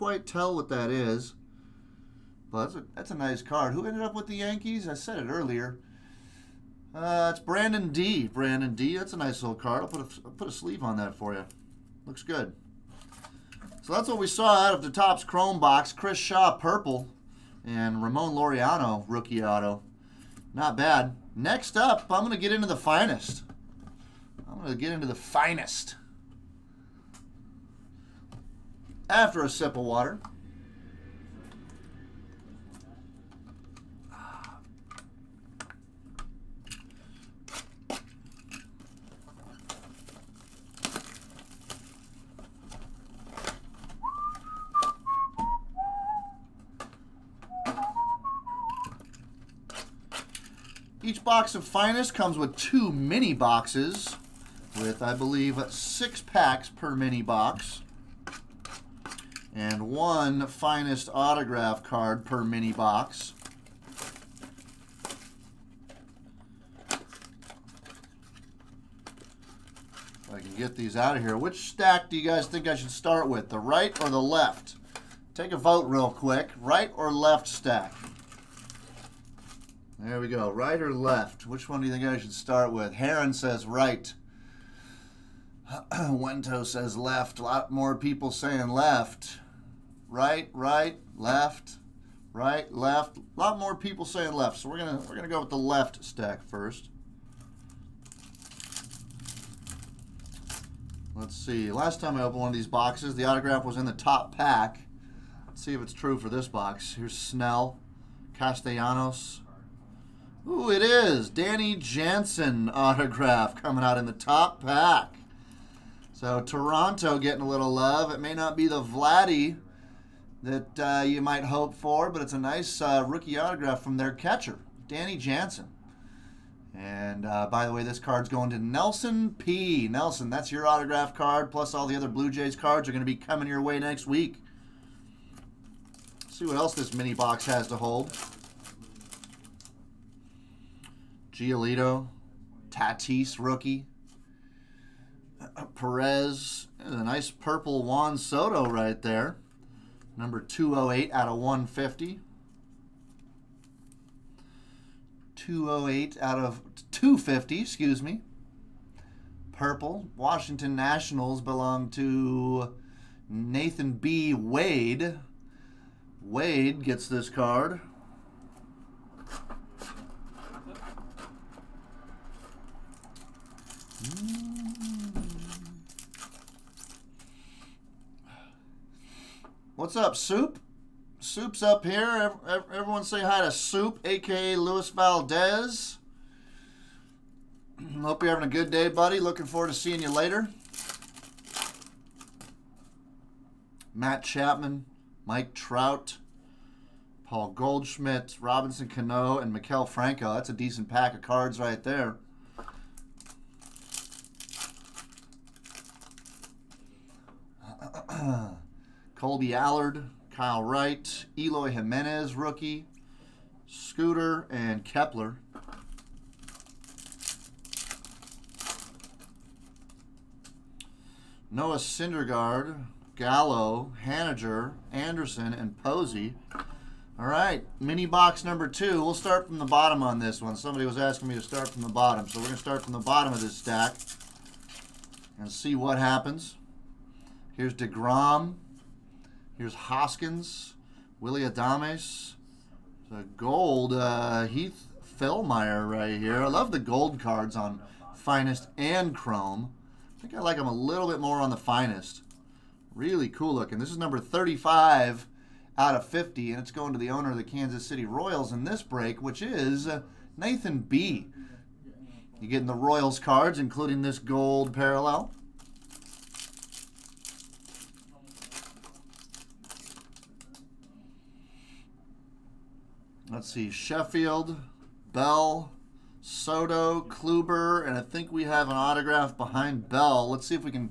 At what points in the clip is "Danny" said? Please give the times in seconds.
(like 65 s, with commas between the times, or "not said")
111 s, 124 s.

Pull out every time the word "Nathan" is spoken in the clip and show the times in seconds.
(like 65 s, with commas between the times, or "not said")
163 s, 260 s.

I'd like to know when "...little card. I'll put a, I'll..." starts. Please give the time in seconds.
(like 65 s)
9 s.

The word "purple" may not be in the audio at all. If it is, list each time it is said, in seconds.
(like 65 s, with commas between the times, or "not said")
16 s, 147 s, 159 s.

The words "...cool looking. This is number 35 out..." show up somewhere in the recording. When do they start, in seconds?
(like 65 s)
253 s.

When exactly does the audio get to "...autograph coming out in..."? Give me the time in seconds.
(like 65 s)
112 s.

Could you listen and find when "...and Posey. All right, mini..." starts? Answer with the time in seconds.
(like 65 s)
225 s.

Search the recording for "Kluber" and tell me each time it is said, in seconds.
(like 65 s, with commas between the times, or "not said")
277 s.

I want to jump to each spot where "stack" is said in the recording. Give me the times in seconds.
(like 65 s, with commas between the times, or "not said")
71 s, 77 s, 96 s, 233 s.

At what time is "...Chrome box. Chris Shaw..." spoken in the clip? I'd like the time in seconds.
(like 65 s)
15 s.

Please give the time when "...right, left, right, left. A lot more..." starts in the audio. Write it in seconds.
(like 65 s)
90 s.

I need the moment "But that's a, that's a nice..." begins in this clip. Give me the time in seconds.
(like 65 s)
2 s.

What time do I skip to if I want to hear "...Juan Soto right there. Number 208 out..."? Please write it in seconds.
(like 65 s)
147 s.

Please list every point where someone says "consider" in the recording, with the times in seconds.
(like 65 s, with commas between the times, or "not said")
not said.